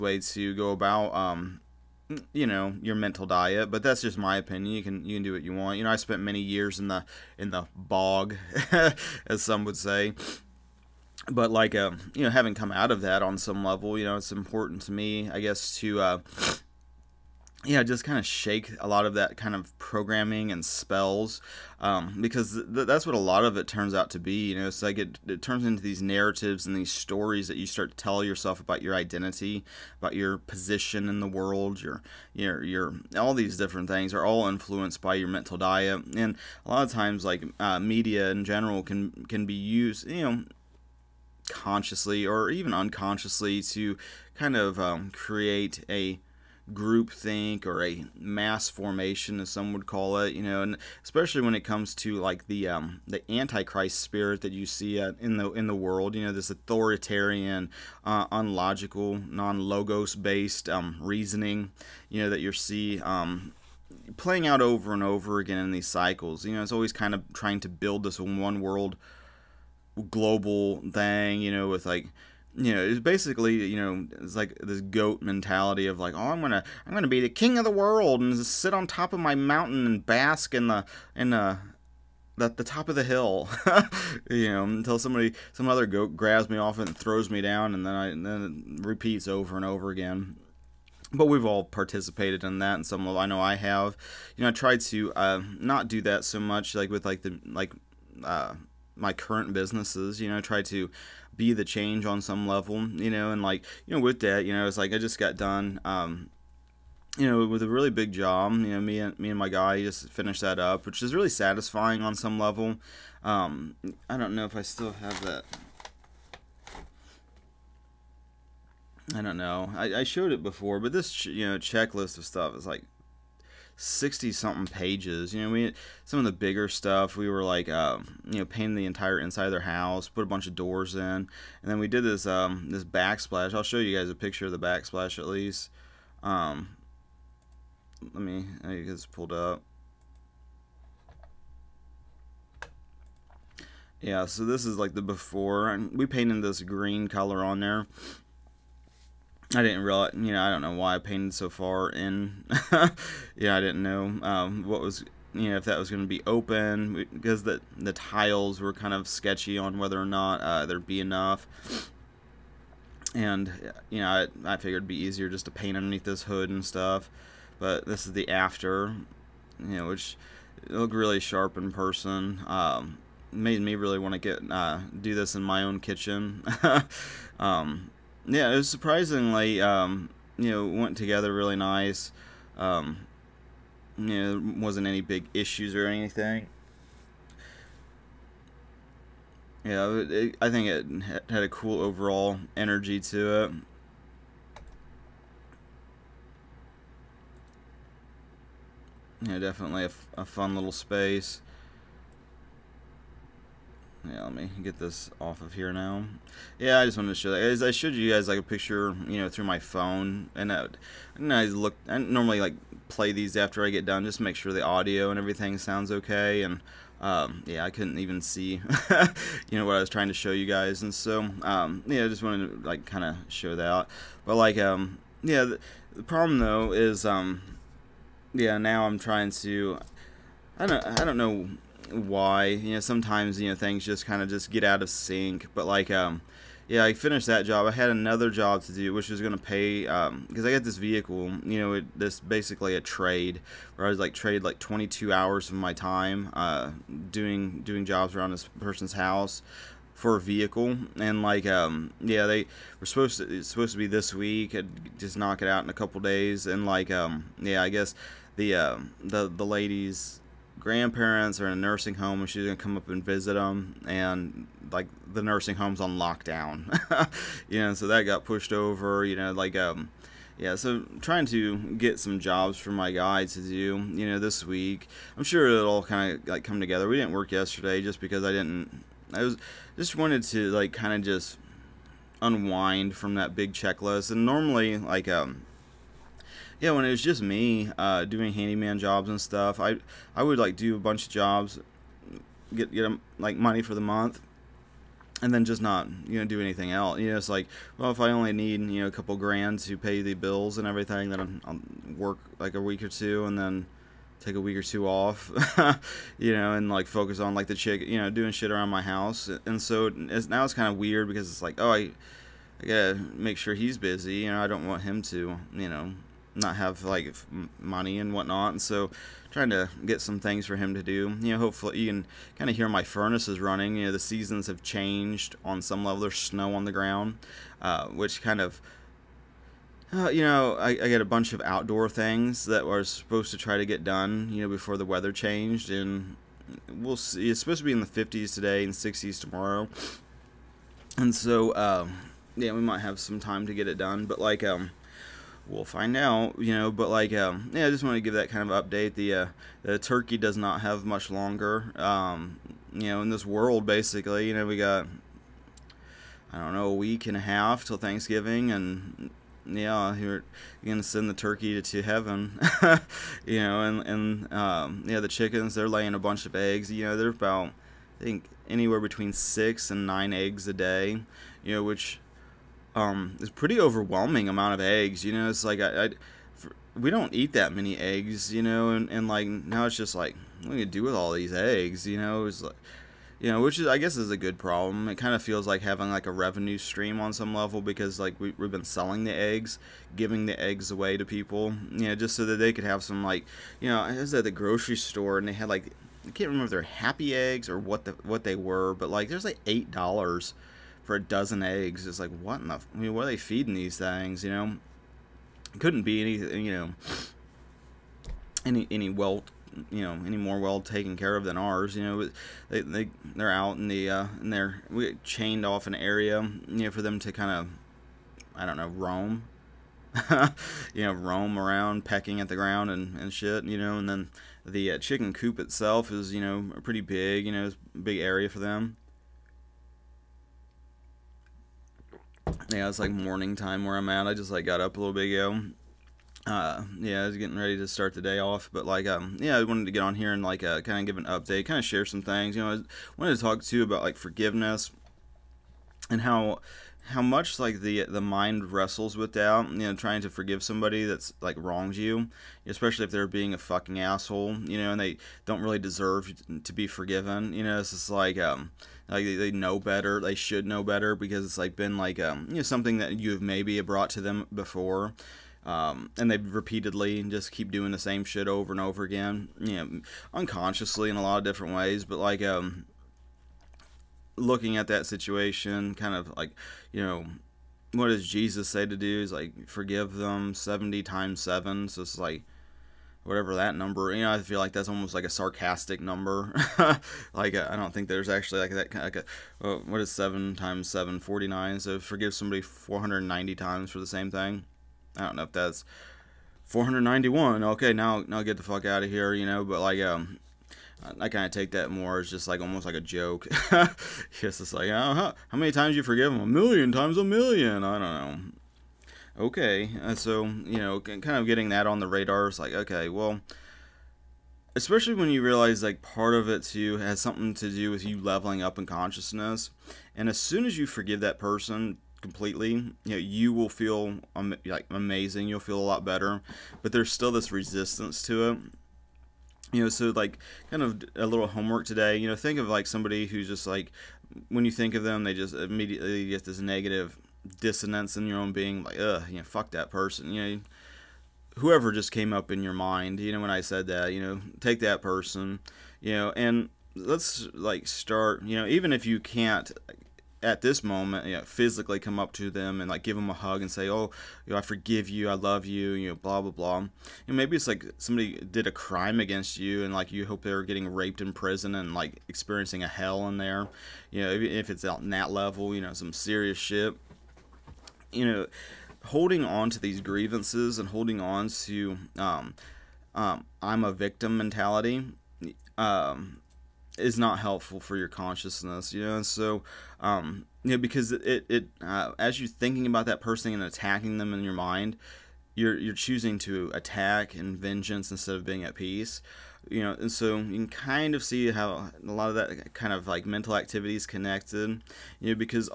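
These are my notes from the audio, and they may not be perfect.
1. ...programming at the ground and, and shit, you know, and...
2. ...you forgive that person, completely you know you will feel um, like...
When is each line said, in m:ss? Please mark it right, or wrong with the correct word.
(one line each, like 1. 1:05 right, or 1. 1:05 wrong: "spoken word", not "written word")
1. 7:01 wrong: "pecking", not "programming"
2. 8:40 right.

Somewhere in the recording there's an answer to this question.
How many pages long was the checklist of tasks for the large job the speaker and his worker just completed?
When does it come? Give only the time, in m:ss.
2:03.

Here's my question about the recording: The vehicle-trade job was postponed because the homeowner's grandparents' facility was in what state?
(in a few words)
lockdown.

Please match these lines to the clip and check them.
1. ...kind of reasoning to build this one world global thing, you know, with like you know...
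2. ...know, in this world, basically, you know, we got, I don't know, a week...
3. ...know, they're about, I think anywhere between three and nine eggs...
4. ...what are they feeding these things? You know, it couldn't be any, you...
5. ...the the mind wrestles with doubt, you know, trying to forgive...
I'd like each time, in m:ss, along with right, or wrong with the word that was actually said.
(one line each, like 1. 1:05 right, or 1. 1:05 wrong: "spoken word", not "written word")
1. 1:06 wrong: "trying", not "reasoning"
2. 5:52 right
3. 6:06 wrong: "six", not "three"
4. 6:42 right
5. 7:27 right.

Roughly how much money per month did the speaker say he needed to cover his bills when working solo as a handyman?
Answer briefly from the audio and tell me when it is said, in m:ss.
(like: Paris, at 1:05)
a couple grand, at 4:58.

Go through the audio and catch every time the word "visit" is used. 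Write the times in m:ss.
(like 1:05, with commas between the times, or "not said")
4:23.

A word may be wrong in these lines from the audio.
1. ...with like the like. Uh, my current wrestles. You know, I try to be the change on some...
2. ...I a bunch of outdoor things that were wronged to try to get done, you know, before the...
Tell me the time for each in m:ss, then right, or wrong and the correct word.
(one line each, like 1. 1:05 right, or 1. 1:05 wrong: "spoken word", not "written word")
1. 1:36 wrong: "businesses", not "wrestles"
2. 5:30 wrong: "supposed", not "wronged".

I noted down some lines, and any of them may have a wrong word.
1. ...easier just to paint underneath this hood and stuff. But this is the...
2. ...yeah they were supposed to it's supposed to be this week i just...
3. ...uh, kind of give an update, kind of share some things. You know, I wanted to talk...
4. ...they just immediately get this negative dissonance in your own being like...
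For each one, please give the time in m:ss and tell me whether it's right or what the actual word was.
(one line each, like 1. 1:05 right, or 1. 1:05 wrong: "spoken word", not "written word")
1. 2:44 right
2. 4:12 right
3. 7:20 right
4. 8:55 right.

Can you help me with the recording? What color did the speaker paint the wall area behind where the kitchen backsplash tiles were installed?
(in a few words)
green.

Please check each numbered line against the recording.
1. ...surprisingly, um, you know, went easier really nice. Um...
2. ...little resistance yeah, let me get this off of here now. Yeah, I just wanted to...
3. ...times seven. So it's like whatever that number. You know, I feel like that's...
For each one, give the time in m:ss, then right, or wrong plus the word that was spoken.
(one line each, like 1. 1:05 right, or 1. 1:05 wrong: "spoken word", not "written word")
1. 2:58 wrong: "together", not "easier"
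2. 3:20 wrong: "space", not "resistance"
3. 8:00 right.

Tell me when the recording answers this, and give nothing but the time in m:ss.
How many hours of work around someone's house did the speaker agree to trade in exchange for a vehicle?
4:04.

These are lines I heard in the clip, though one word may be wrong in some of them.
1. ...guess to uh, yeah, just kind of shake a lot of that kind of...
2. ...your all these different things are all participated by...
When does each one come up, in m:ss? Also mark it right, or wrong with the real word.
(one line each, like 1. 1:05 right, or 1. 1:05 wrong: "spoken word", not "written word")
1. 0:15 right
2. 0:32 wrong: "influenced", not "participated".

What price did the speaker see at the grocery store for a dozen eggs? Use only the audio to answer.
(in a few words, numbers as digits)
$8.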